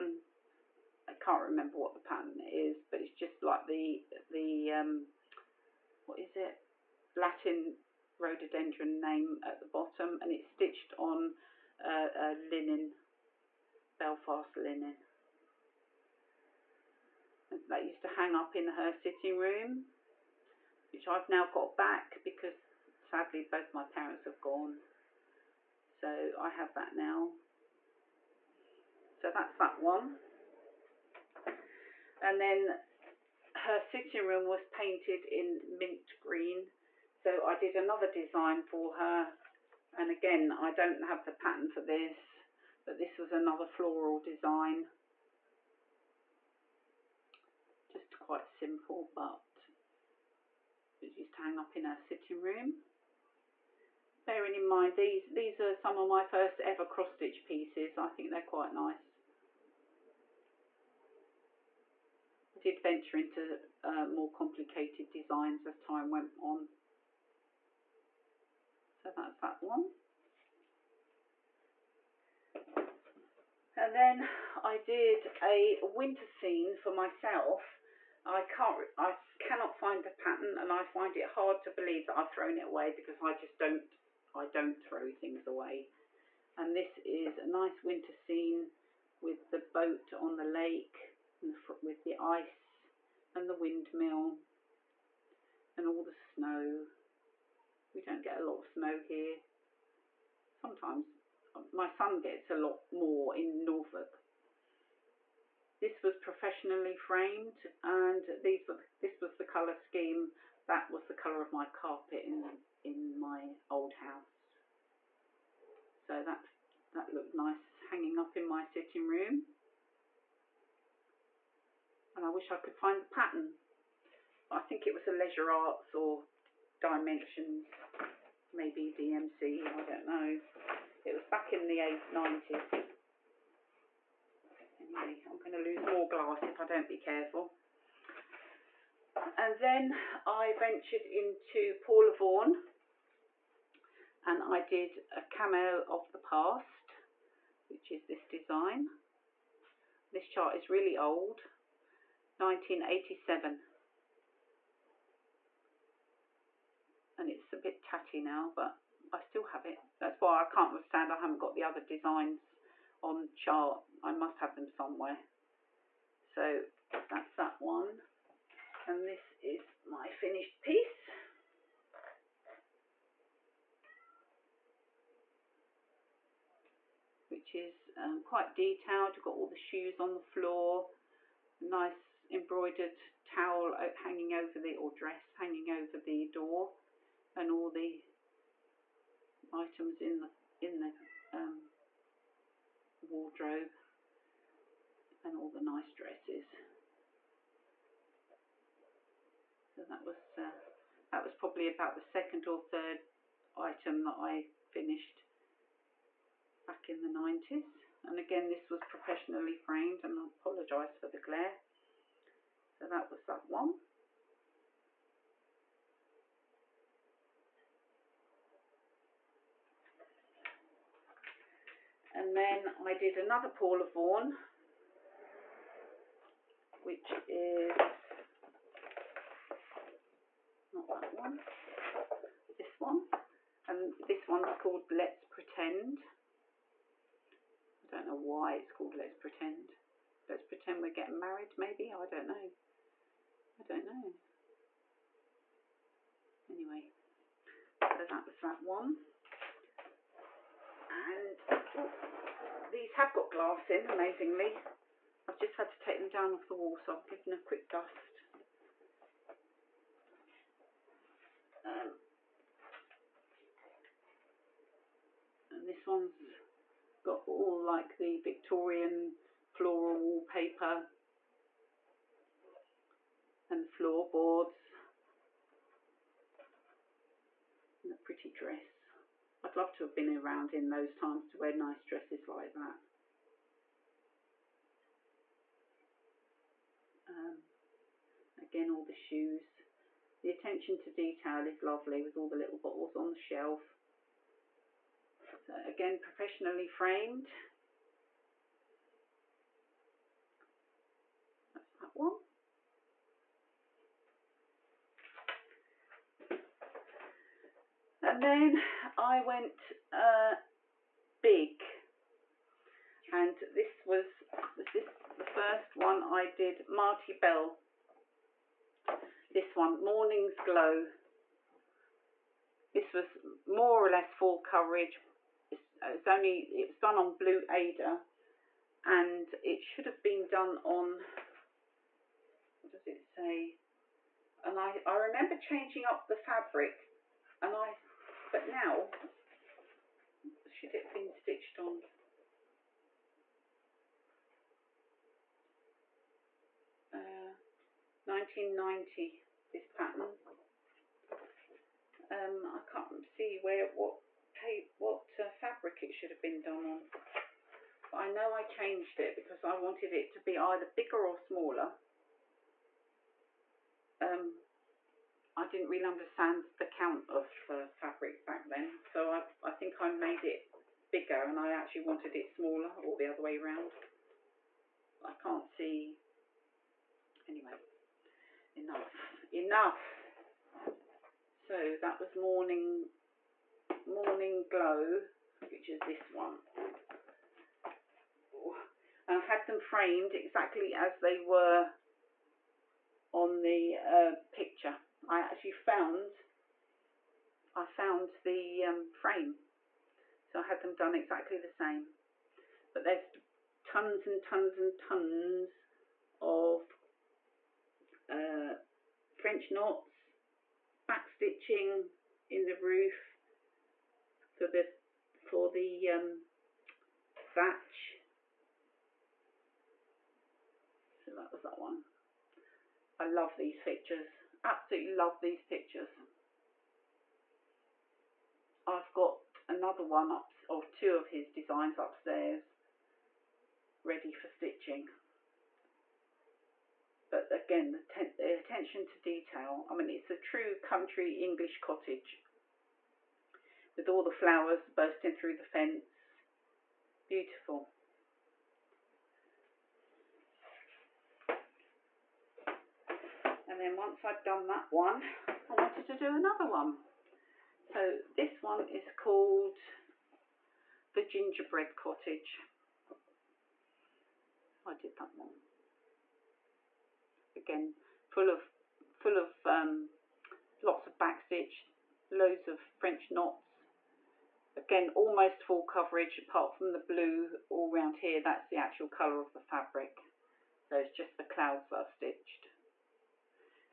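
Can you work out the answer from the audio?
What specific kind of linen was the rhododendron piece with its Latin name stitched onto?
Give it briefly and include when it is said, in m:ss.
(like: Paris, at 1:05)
Belfast linen, at 0:13.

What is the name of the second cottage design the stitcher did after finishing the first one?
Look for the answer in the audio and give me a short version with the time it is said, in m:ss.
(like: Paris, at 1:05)
Gingerbread Cottage, at 7:41.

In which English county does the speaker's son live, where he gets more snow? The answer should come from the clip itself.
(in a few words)
Norfolk.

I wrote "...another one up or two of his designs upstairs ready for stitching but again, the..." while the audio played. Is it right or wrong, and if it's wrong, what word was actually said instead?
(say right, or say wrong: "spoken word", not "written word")
right.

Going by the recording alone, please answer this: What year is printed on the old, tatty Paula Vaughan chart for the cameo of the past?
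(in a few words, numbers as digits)
1987.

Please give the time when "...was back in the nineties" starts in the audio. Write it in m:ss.
2:11.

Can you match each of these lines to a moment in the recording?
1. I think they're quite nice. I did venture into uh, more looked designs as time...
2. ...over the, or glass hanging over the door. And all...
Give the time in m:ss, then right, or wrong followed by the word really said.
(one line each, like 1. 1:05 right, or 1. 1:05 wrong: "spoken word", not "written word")
1. 0:57 wrong: "complicated", not "looked"
2. 3:04 wrong: "dress", not "glass".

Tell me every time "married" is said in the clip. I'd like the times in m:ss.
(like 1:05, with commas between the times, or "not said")
4:01.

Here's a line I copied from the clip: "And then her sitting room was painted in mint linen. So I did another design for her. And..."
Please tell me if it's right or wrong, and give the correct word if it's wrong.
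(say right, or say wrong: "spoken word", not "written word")
wrong: "green", not "linen".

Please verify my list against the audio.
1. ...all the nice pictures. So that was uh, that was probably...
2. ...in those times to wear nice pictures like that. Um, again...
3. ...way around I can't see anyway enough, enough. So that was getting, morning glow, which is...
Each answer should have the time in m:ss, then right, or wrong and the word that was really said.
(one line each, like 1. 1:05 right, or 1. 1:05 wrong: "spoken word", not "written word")
1. 3:15 wrong: "dresses", not "pictures"
2. 4:40 wrong: "dresses", not "pictures"
3. 6:13 wrong: "morning", not "getting".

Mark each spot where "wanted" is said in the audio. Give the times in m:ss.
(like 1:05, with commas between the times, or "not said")
5:59, 6:11, 7:35.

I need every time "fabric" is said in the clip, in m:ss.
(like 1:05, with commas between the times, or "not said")
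5:36, 5:55, 6:07, 7:59.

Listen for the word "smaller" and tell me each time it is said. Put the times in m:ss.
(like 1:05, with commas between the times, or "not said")
6:01, 6:12.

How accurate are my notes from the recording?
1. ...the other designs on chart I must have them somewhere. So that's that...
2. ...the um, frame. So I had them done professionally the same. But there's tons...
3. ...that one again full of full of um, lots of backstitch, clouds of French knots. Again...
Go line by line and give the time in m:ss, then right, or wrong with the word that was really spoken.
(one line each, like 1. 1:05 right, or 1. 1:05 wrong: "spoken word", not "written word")
1. 2:41 right
2. 6:38 wrong: "exactly", not "professionally"
3. 7:44 wrong: "loads", not "clouds".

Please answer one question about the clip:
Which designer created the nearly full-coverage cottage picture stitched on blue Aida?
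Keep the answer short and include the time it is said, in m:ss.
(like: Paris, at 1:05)
Marty Bell, at 5:16.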